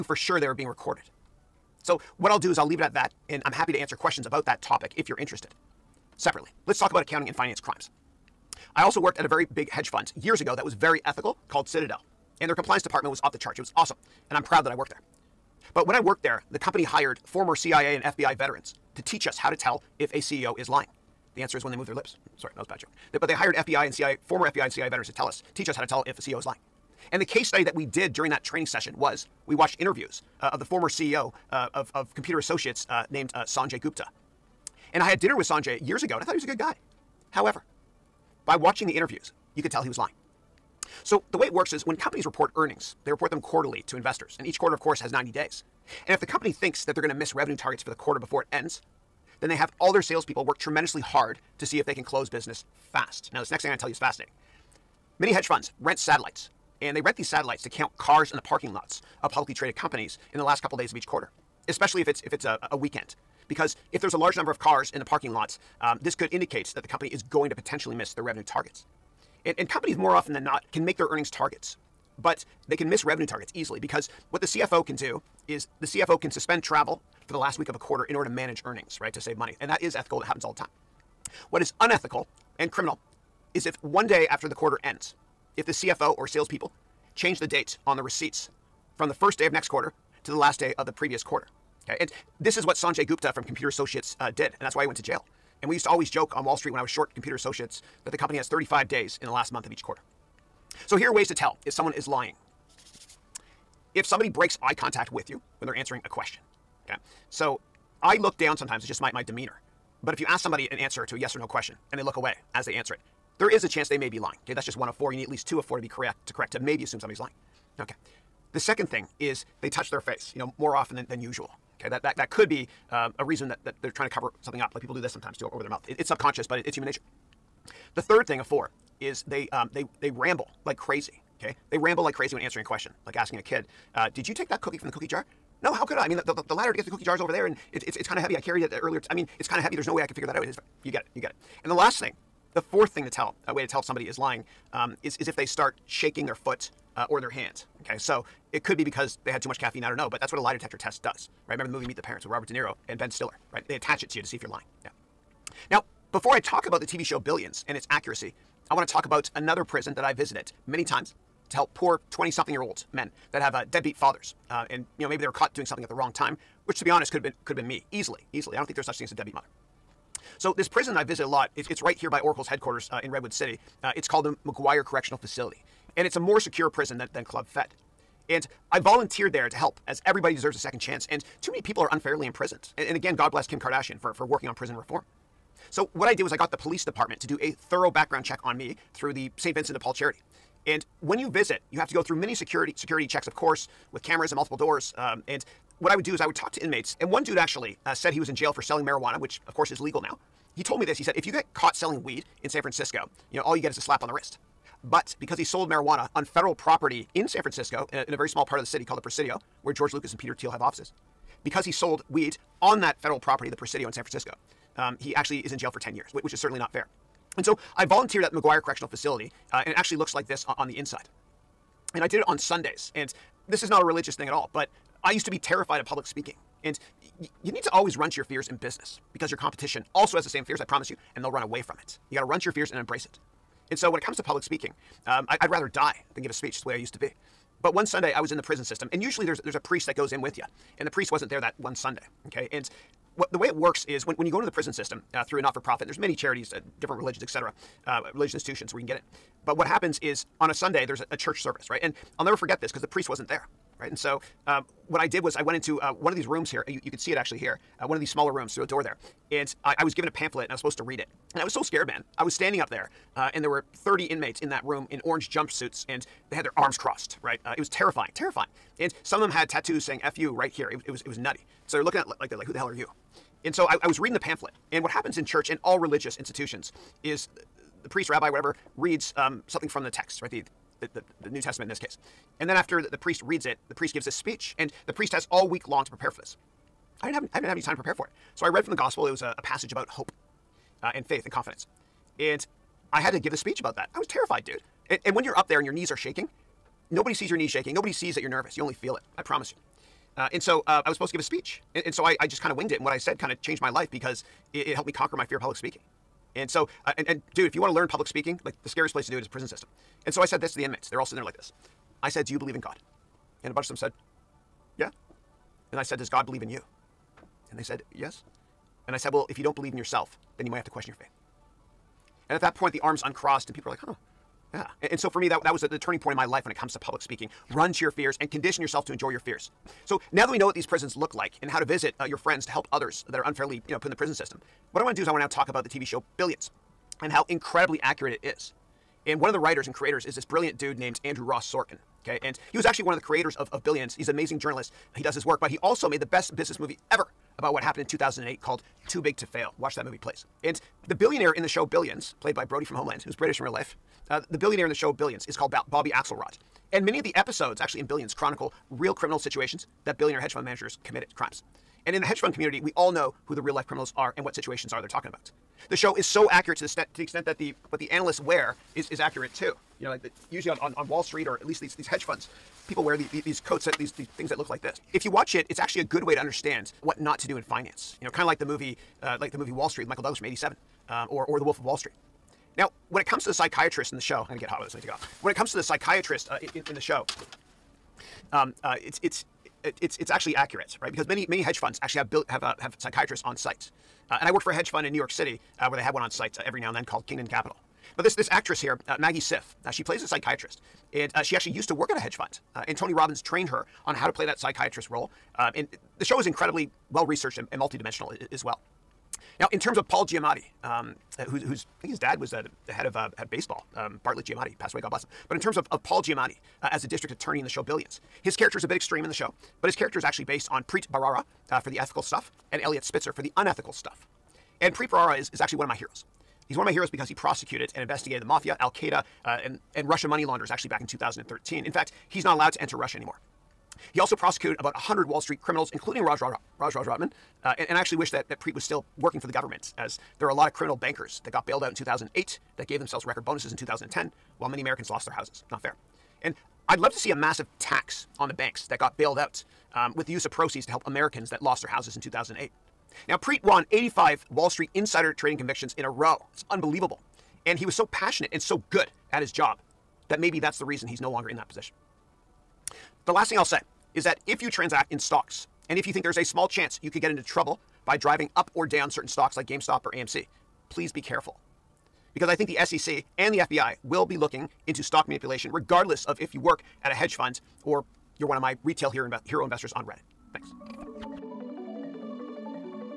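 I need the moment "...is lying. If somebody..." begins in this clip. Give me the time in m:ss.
1:41.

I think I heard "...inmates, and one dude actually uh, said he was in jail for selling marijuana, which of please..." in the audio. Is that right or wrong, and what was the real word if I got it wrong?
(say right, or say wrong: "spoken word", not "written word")
wrong: "course", not "please".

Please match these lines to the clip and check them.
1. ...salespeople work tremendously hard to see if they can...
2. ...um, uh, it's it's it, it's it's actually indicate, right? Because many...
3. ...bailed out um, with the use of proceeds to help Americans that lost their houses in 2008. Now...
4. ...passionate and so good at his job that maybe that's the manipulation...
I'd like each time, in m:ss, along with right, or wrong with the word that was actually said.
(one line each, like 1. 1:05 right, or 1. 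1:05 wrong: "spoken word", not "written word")
1. 0:50 right
2. 6:28 wrong: "accurate", not "indicate"
3. 7:28 right
4. 7:37 wrong: "reason", not "manipulation".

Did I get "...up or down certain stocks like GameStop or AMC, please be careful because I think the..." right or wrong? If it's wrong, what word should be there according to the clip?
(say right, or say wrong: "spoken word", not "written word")
right.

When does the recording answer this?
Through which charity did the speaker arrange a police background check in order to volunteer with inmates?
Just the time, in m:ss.
3:09.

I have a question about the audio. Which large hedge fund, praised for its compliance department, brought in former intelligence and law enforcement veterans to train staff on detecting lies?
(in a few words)
Citadel.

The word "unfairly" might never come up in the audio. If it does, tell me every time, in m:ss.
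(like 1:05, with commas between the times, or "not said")
3:01, 5:33.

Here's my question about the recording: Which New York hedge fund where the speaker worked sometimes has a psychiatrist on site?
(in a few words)
Kingdon Capital.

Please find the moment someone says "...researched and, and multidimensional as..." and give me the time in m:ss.
6:47.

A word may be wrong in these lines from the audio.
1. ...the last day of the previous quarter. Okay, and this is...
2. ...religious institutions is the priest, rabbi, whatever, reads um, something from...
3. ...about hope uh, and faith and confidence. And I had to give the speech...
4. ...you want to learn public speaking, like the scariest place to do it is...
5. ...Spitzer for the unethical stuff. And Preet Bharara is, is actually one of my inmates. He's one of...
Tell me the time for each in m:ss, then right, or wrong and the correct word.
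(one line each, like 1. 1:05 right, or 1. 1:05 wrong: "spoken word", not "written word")
1. 1:30 right
2. 4:35 right
3. 4:49 right
4. 5:07 right
5. 7:02 wrong: "heroes", not "inmates".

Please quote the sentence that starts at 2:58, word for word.
And I volunteered there to help, as everybody deserves a second chance.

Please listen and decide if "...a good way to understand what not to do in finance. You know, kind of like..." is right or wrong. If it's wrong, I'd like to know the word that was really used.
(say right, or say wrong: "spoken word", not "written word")
right.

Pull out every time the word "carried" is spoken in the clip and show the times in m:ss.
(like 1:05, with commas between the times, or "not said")
2:18.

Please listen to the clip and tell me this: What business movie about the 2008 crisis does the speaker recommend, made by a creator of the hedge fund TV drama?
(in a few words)
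Too Big to Fail.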